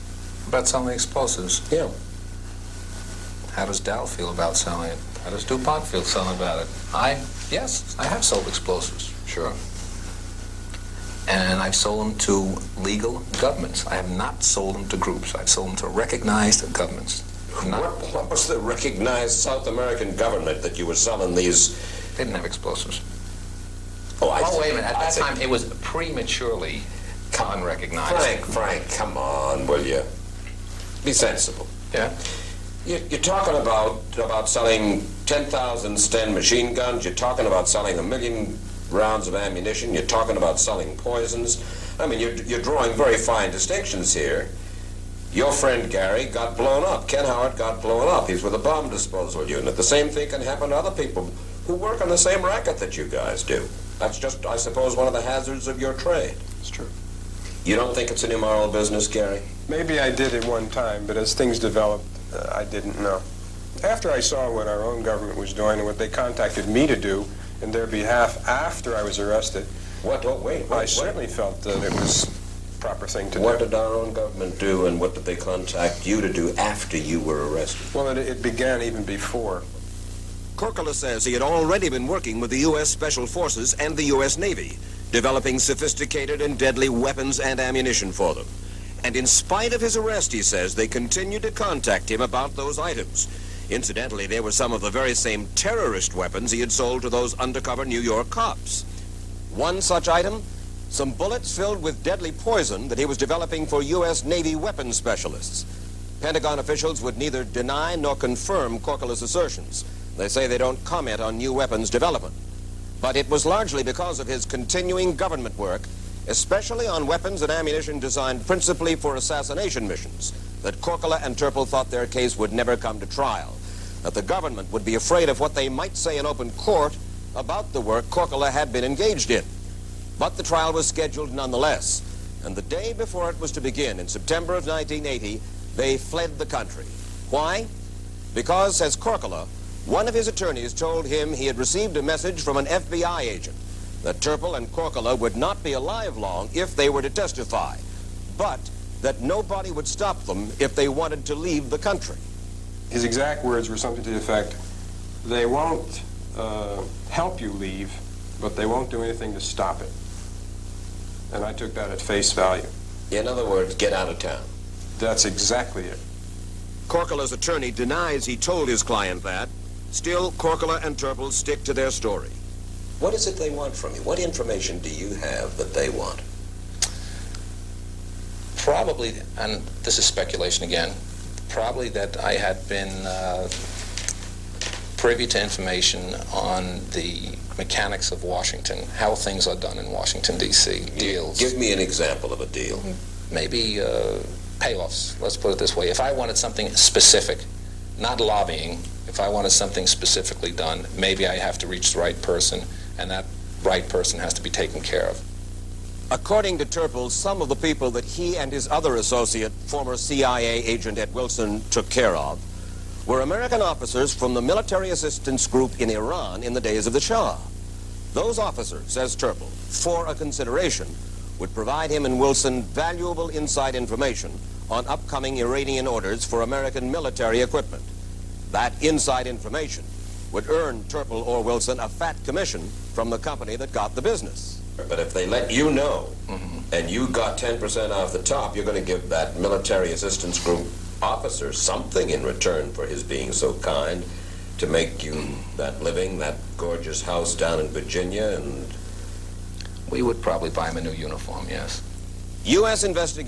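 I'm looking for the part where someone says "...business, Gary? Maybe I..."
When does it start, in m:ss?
0:58.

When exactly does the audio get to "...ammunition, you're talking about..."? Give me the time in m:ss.
0:39.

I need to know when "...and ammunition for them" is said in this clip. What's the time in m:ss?
1:27.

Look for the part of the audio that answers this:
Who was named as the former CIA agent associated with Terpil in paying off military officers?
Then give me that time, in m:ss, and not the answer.
3:30.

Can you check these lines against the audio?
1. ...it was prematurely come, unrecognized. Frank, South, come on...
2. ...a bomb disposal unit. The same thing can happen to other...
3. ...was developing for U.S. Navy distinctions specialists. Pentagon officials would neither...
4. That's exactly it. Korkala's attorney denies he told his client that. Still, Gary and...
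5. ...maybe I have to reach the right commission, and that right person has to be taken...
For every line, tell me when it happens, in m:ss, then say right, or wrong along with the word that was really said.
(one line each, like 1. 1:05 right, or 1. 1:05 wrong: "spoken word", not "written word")
1. 0:25 wrong: "Frank", not "South"
2. 0:48 right
3. 1:43 wrong: "weapons", not "distinctions"
4. 2:44 wrong: "Korkala", not "Gary"
5. 3:20 wrong: "person", not "commission".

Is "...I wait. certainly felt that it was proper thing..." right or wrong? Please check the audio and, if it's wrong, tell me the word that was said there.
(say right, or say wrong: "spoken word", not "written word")
right.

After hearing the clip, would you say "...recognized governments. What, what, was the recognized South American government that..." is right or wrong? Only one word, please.
right.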